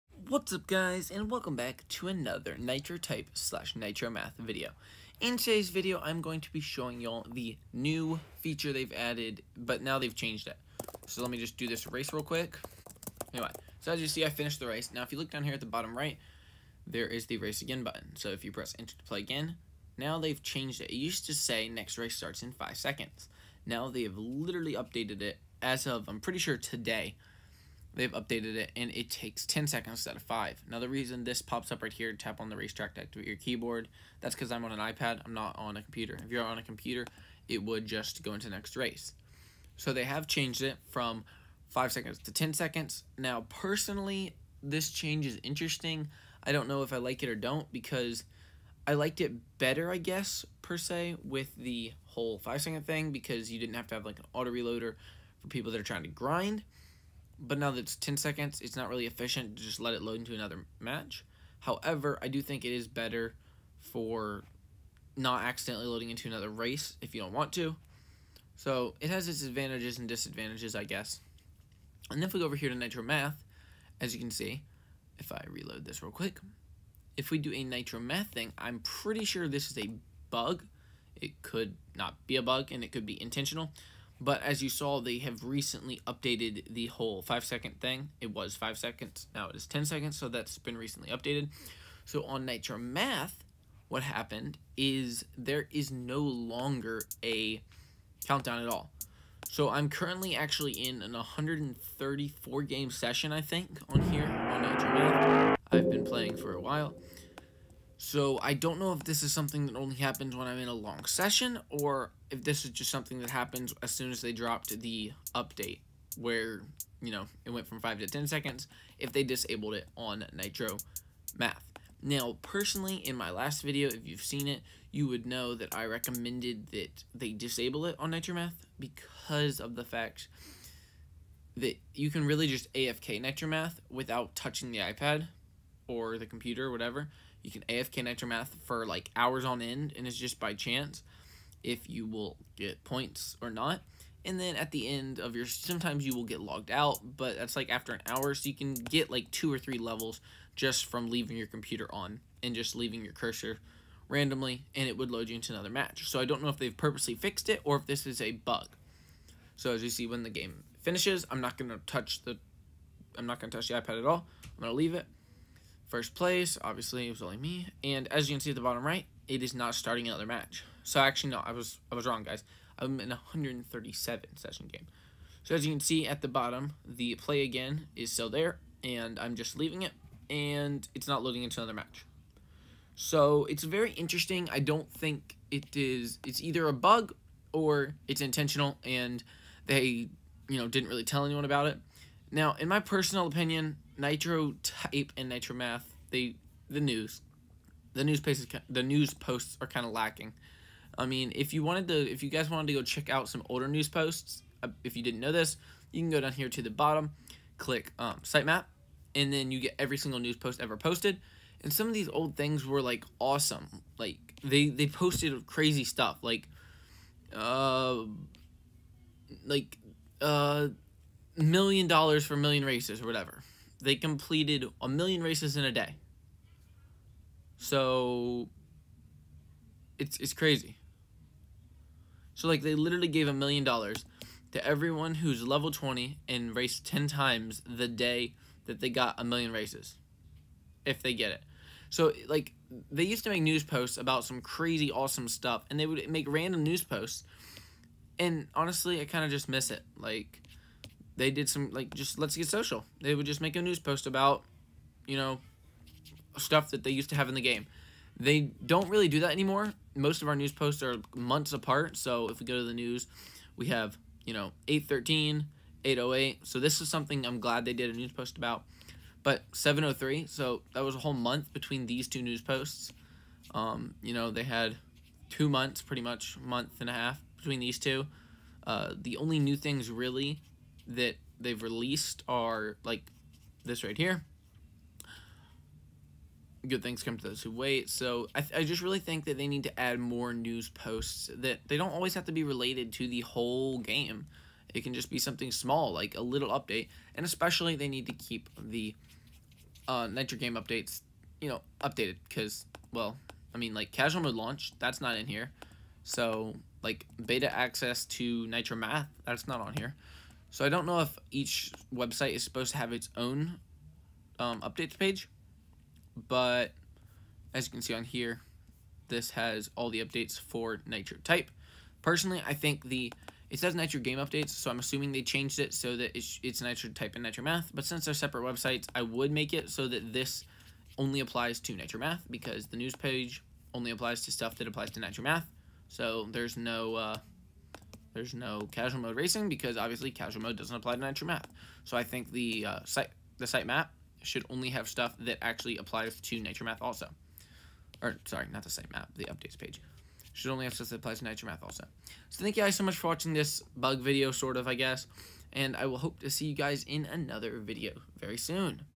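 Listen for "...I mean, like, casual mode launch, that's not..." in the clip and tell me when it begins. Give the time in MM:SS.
05:03.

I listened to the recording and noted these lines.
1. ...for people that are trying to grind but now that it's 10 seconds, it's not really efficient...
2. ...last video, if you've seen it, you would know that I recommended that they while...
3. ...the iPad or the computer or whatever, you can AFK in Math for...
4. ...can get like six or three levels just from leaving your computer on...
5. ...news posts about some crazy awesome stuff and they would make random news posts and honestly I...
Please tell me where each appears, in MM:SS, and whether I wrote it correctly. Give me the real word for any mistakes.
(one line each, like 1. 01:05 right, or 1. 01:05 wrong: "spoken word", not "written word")
1. 00:55 right
2. 02:03 wrong: "disable", not "while"
3. 02:14 wrong: "Aftermath", not "Math"
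4. 02:28 wrong: "two", not "six"
5. 04:03 right.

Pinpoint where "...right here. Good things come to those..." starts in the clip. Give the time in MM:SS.
04:43.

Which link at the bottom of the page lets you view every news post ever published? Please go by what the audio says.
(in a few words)
sitemap.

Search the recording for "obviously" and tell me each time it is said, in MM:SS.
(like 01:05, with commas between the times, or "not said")
02:46, 05:39.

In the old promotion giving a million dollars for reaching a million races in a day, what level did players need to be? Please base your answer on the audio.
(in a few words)
level 20.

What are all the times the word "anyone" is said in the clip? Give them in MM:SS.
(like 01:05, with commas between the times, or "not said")
03:11.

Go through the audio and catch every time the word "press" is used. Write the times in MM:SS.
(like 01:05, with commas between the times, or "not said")
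00:18.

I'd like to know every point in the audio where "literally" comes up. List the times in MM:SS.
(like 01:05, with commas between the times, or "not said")
00:24, 03:52.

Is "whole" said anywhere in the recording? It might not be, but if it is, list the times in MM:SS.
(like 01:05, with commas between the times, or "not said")
00:52, 01:26, 04:30, 04:53.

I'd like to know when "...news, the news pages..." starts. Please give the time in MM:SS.
03:16.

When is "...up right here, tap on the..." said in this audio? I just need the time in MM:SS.
00:31.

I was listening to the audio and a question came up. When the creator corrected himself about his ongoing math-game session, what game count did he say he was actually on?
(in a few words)
137.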